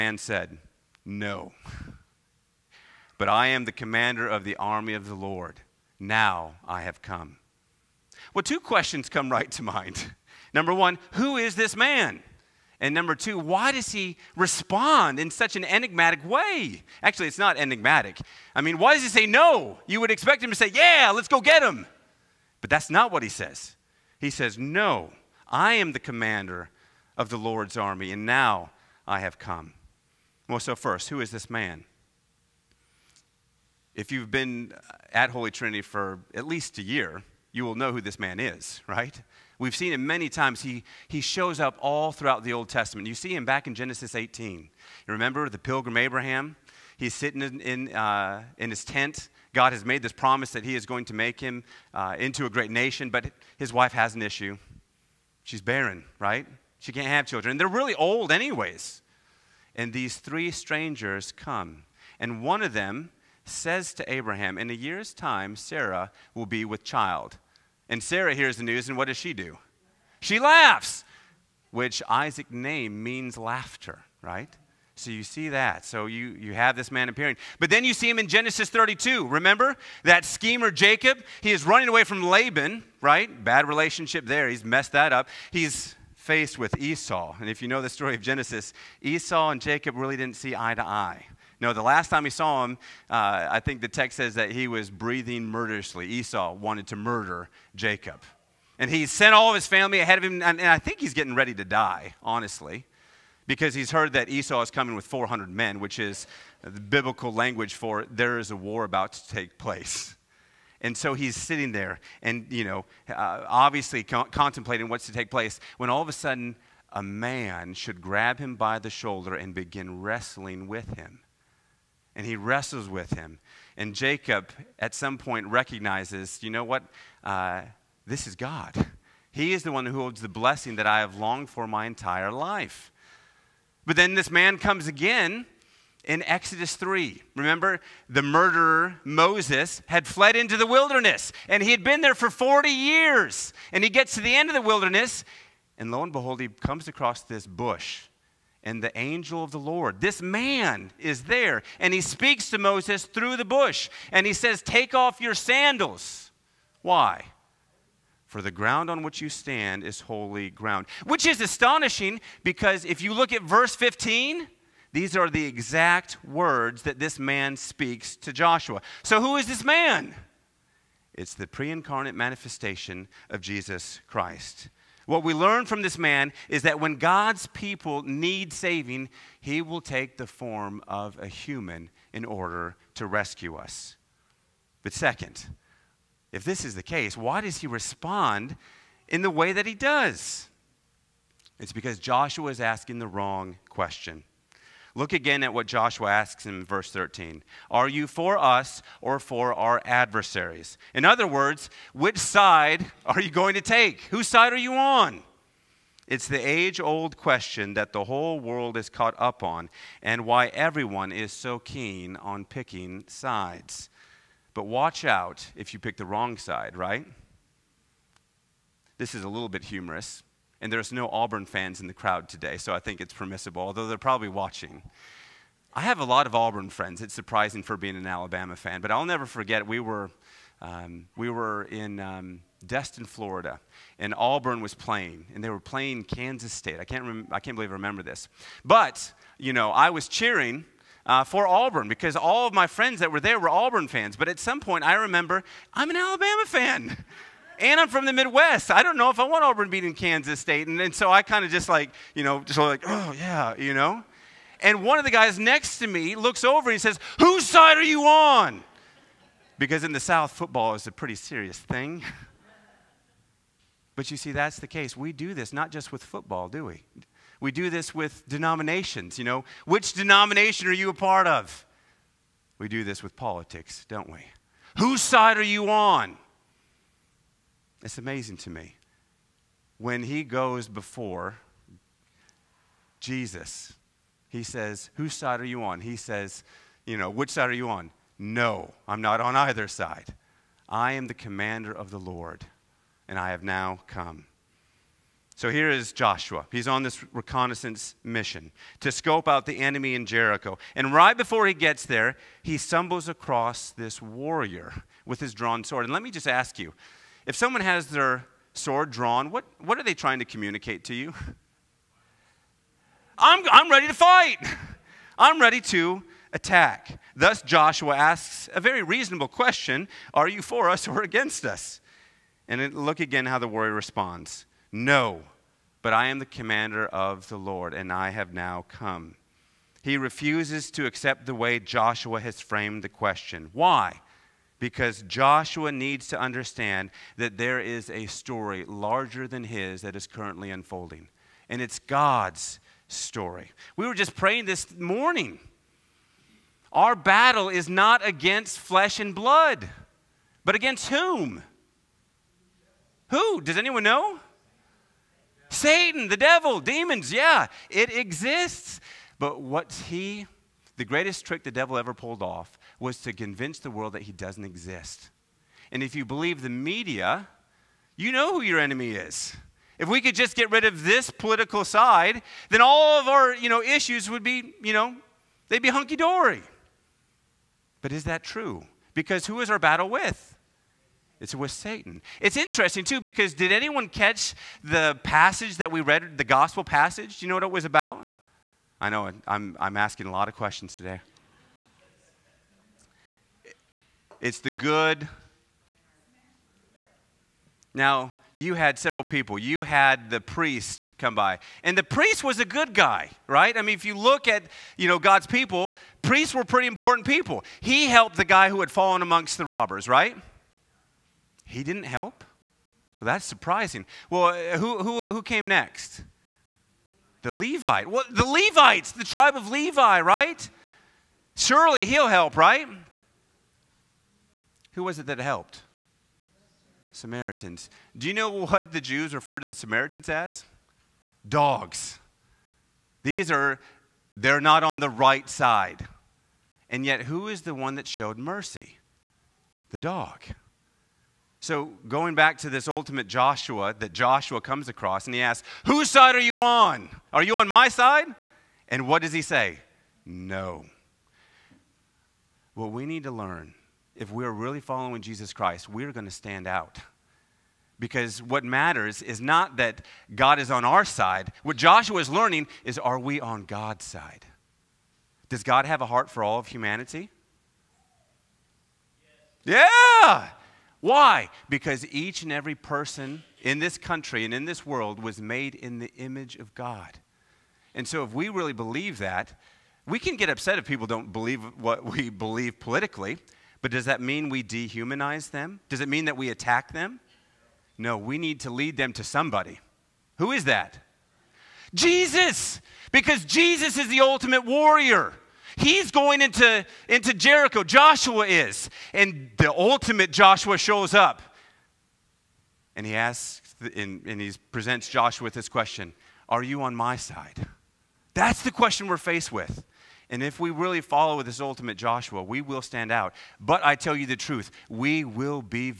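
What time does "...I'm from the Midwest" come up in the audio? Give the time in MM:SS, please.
04:07.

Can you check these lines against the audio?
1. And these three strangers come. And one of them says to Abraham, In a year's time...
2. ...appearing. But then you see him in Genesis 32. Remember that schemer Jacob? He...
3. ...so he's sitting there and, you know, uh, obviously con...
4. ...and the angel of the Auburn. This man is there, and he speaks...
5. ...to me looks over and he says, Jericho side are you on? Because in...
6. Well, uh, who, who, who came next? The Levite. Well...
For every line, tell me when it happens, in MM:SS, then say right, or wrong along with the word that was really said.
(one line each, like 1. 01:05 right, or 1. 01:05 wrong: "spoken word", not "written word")
1. 00:59 right
2. 01:17 right
3. 01:50 right
4. 02:28 wrong: "Lord", not "Auburn"
5. 04:15 wrong: "Whose", not "Jericho"
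6. 06:54 right.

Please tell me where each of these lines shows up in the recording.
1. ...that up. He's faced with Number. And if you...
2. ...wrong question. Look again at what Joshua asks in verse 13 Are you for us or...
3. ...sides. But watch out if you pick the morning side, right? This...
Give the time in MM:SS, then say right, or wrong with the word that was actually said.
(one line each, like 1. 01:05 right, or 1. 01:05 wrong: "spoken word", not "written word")
1. 01:24 wrong: "Esau", not "Number"
2. 03:13 right
3. 03:33 wrong: "wrong", not "morning".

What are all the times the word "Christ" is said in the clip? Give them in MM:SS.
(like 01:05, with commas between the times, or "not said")
02:54, 07:35.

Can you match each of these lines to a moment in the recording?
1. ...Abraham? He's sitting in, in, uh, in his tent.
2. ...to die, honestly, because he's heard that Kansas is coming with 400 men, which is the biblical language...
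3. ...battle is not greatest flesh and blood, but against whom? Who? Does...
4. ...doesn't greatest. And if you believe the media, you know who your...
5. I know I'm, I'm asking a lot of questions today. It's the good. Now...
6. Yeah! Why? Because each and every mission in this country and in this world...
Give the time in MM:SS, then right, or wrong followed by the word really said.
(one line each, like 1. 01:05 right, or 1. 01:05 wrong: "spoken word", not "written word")
1. 00:45 right
2. 01:41 wrong: "Esau", not "Kansas"
3. 05:46 wrong: "against", not "greatest"
4. 06:04 wrong: "exist", not "greatest"
5. 06:28 right
6. 07:50 wrong: "person", not "mission".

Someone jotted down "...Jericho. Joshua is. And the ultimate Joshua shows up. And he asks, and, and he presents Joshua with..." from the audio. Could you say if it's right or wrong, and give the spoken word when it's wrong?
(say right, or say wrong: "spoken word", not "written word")
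right.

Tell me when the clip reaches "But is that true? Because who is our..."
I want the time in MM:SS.
06:17.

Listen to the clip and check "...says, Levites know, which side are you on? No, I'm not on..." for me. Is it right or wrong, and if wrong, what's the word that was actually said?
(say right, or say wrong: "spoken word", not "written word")
wrong: "You", not "Levites".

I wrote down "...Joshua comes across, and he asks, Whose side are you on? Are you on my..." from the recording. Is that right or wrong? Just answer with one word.
right.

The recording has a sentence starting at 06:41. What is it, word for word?
And the priest was a good guy, right?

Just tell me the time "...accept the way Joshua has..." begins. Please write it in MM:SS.
05:30.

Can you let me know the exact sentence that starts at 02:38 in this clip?
For the ground on which you stand is holy ground.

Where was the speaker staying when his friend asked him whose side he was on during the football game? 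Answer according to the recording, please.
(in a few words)
Destin, Florida.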